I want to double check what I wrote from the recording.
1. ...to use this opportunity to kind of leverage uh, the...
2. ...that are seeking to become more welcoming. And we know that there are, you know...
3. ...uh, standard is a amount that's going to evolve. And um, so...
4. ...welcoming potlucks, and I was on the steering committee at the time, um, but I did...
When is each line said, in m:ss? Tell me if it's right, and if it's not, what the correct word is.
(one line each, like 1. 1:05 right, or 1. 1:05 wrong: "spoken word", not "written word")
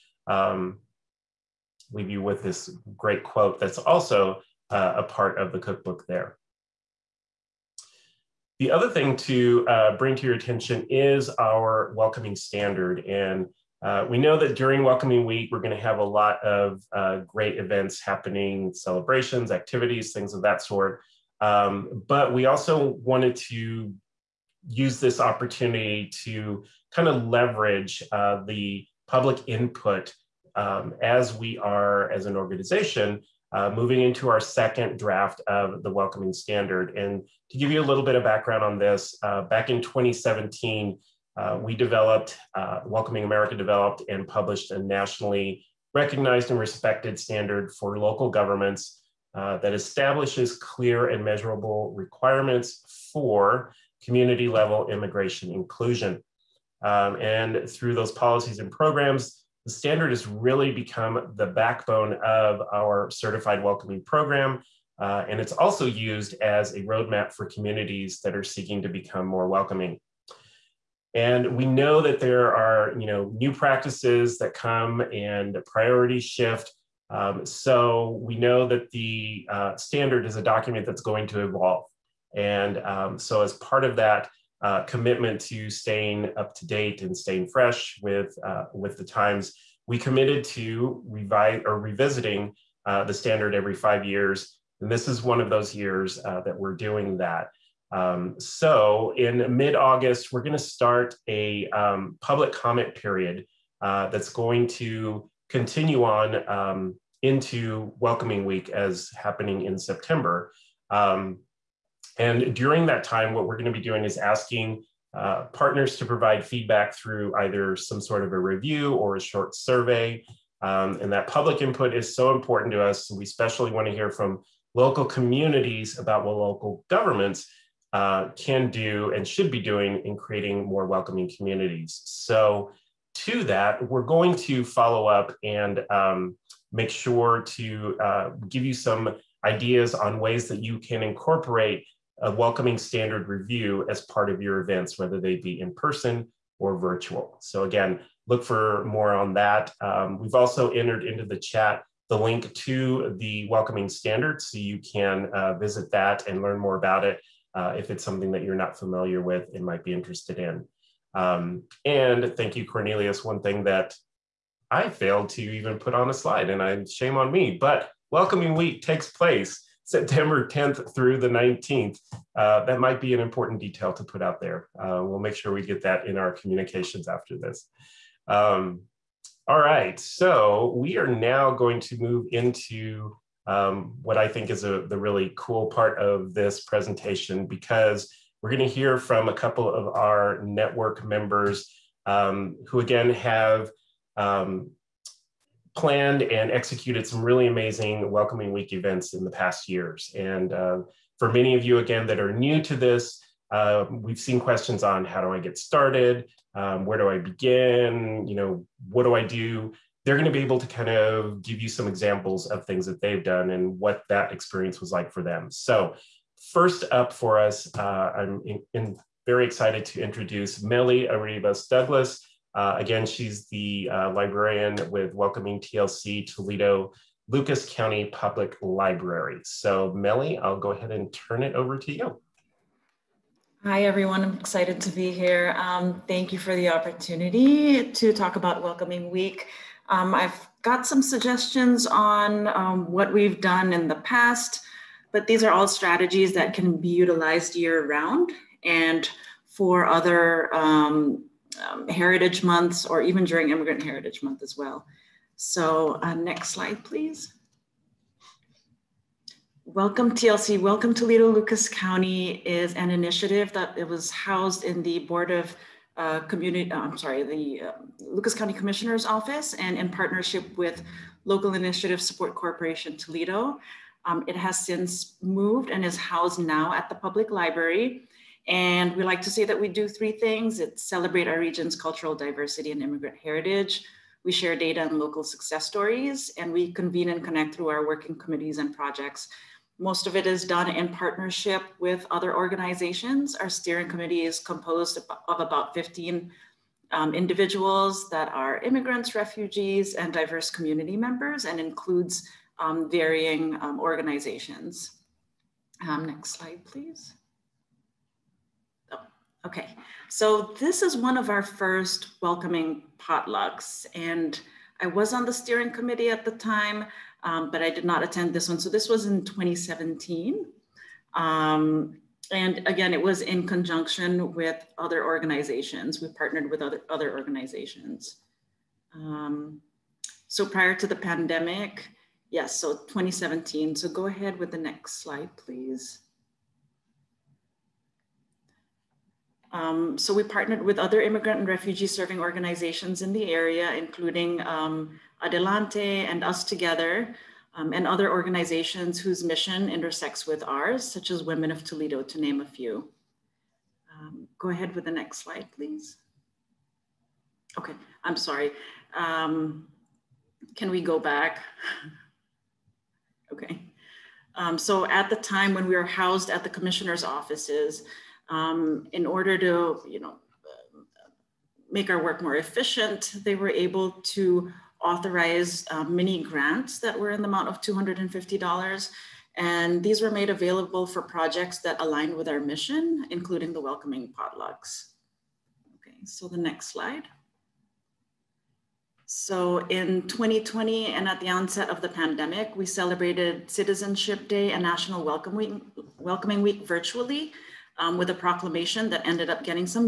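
1. 0:23 right
2. 1:08 right
3. 1:19 wrong: "document", not "amount"
4. 5:12 right.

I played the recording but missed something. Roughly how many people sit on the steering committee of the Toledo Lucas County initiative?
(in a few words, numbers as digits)
about 15.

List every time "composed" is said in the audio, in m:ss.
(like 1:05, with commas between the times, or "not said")
4:54.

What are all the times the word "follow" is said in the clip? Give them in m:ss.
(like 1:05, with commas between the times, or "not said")
2:14.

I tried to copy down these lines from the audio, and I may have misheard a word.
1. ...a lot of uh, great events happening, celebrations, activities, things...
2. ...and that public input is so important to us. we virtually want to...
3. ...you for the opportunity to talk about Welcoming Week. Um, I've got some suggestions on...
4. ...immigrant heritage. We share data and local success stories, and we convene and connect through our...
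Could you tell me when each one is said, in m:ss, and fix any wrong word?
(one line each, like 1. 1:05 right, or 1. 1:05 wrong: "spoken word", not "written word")
1. 0:15 right
2. 2:01 wrong: "especially", not "virtually"
3. 3:56 right
4. 4:42 right.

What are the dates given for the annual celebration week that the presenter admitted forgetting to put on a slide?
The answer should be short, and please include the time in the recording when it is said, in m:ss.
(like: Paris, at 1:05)
September 10th through 19th, at 2:49.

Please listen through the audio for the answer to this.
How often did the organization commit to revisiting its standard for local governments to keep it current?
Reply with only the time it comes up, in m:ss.
1:33.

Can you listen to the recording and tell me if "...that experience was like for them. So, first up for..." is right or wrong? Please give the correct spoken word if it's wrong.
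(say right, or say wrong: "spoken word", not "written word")
right.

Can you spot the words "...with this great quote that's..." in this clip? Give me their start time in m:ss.
0:02.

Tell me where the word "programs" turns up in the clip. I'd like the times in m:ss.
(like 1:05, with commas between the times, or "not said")
0:58, 1:04.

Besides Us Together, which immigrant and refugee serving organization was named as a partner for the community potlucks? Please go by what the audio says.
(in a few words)
Adelante.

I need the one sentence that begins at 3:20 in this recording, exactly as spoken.
And uh, for many of you, again, that are new to this, uh, we've seen questions on how do I get started?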